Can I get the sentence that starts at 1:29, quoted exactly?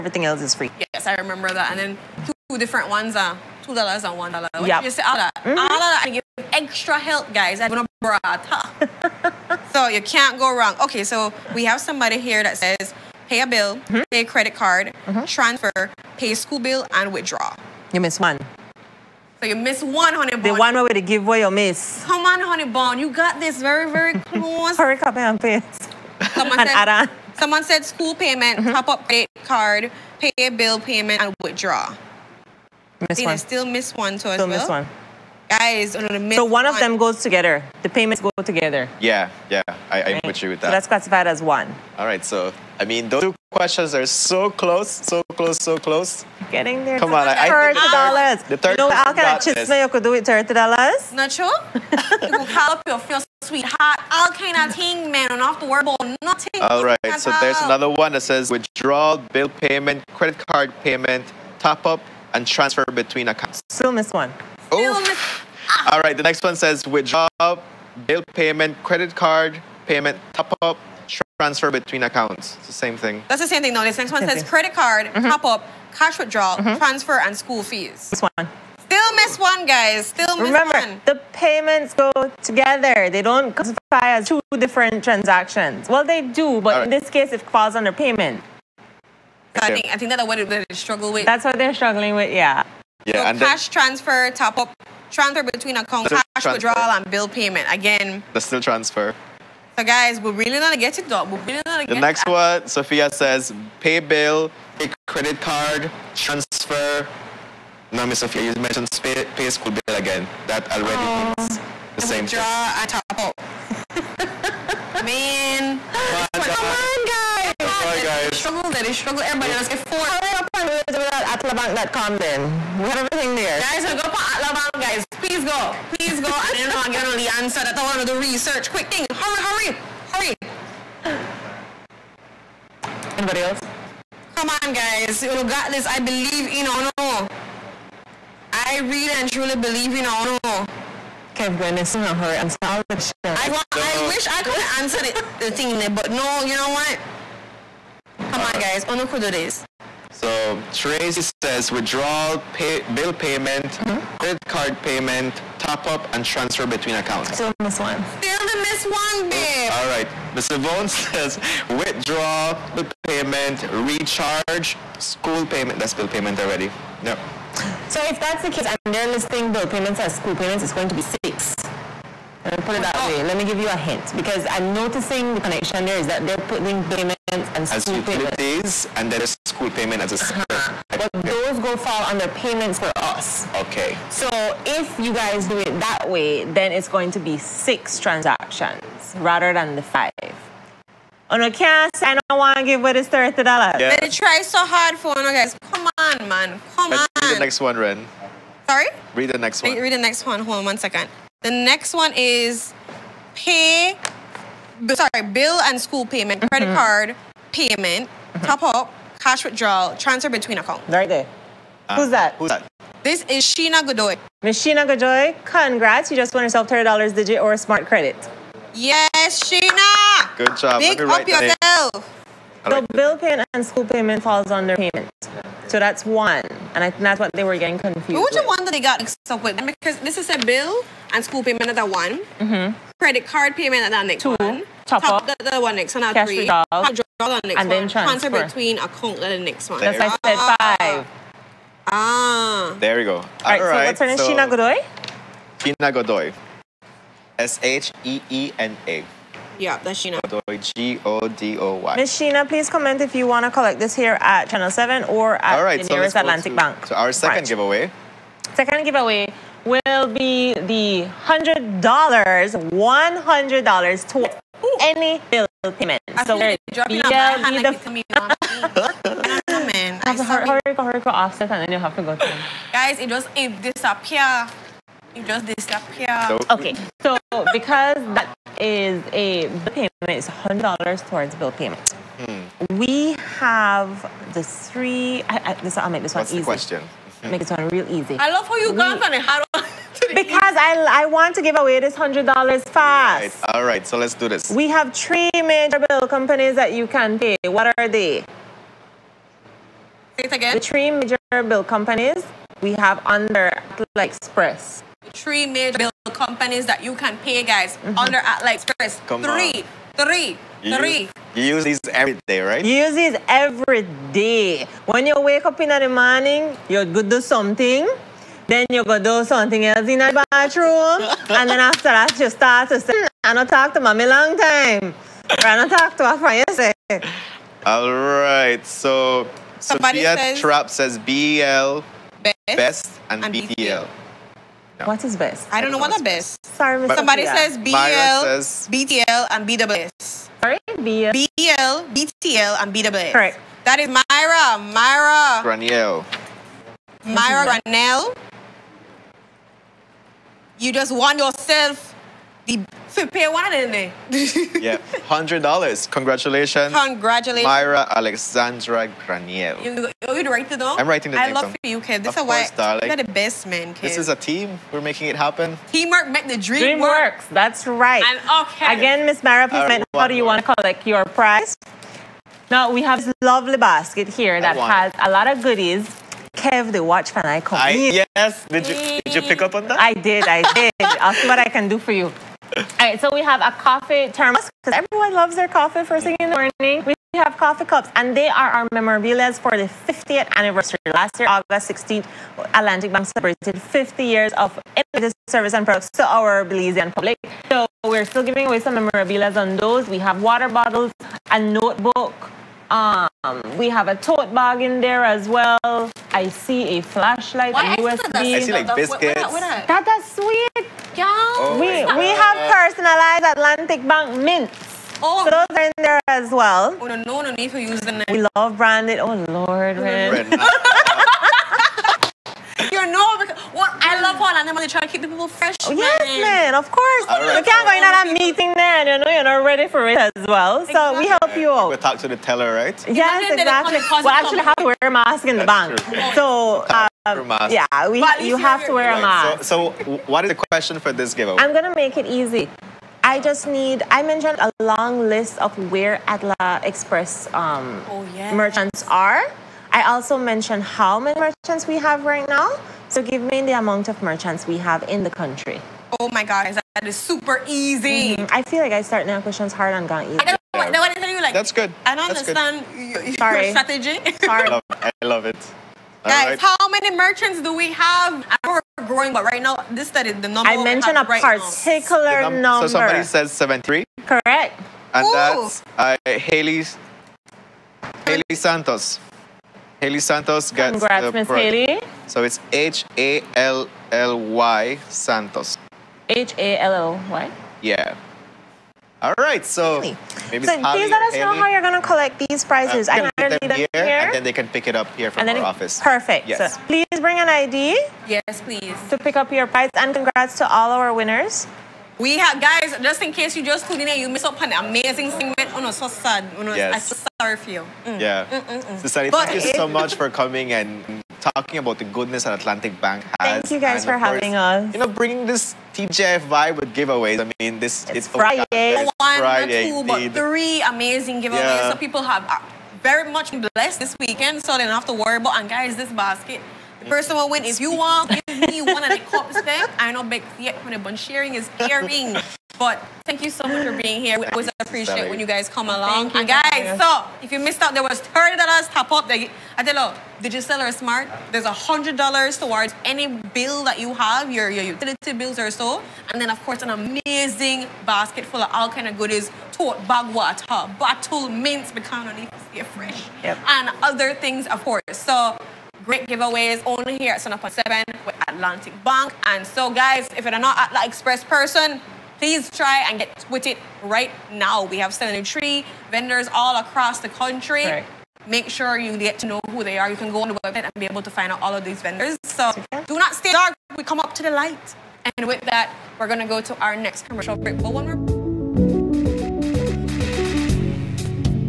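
So I think I think that's what they struggle with.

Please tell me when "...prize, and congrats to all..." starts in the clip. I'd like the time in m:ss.
8:19.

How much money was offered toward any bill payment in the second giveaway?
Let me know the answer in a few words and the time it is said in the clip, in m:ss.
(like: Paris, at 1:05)
$100, at 4:18.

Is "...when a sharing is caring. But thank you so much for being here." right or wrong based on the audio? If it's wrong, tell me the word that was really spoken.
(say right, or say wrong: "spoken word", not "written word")
right.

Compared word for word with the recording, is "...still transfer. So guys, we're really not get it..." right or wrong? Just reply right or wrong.
right.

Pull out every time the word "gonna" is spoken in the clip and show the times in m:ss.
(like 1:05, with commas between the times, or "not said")
0:07, 5:16, 8:11.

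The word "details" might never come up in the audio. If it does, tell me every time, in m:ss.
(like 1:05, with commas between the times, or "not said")
not said.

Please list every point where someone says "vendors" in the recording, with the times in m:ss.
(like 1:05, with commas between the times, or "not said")
9:25, 9:31.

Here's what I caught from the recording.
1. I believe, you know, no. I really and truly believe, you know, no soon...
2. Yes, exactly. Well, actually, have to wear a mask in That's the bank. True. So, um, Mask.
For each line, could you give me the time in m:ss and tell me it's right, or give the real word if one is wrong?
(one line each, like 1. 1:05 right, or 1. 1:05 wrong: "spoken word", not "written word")
1. 2:15 right
2. 7:12 right.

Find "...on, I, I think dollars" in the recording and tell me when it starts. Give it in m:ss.
0:47.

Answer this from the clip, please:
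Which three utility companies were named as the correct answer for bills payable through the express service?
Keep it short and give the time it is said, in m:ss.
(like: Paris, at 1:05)
BEL, BTL, and BWS, at 5:41.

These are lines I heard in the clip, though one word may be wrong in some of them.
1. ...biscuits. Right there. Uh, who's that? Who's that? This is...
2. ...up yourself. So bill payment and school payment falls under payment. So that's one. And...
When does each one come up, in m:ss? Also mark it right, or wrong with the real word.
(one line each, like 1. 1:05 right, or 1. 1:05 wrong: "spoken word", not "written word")
1. 3:30 wrong: "accounts", not "biscuits"
2. 3:41 right.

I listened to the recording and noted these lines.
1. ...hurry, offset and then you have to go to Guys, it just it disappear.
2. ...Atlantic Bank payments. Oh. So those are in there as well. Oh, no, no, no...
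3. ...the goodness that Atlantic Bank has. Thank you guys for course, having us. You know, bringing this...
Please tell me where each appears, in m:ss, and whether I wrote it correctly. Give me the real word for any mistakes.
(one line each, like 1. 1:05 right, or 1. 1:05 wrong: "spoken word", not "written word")
1. 4:30 right
2. 6:53 wrong: "mints", not "payments"
3. 8:31 right.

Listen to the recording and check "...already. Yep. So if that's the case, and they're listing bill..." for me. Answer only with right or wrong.
right.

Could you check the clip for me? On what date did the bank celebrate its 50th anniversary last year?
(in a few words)
August 16th.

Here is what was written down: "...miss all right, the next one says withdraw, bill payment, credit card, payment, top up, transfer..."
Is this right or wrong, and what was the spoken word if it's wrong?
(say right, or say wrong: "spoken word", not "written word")
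right.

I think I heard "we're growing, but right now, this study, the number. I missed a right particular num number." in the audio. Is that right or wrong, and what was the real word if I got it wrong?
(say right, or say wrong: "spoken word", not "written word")
wrong: "mentioned", not "missed".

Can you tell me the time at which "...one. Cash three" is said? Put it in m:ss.
3:55.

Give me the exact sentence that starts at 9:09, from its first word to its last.
Tote bag water, bottle mints, because I need to stay fresh.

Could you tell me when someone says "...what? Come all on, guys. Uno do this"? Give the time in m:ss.
2:26.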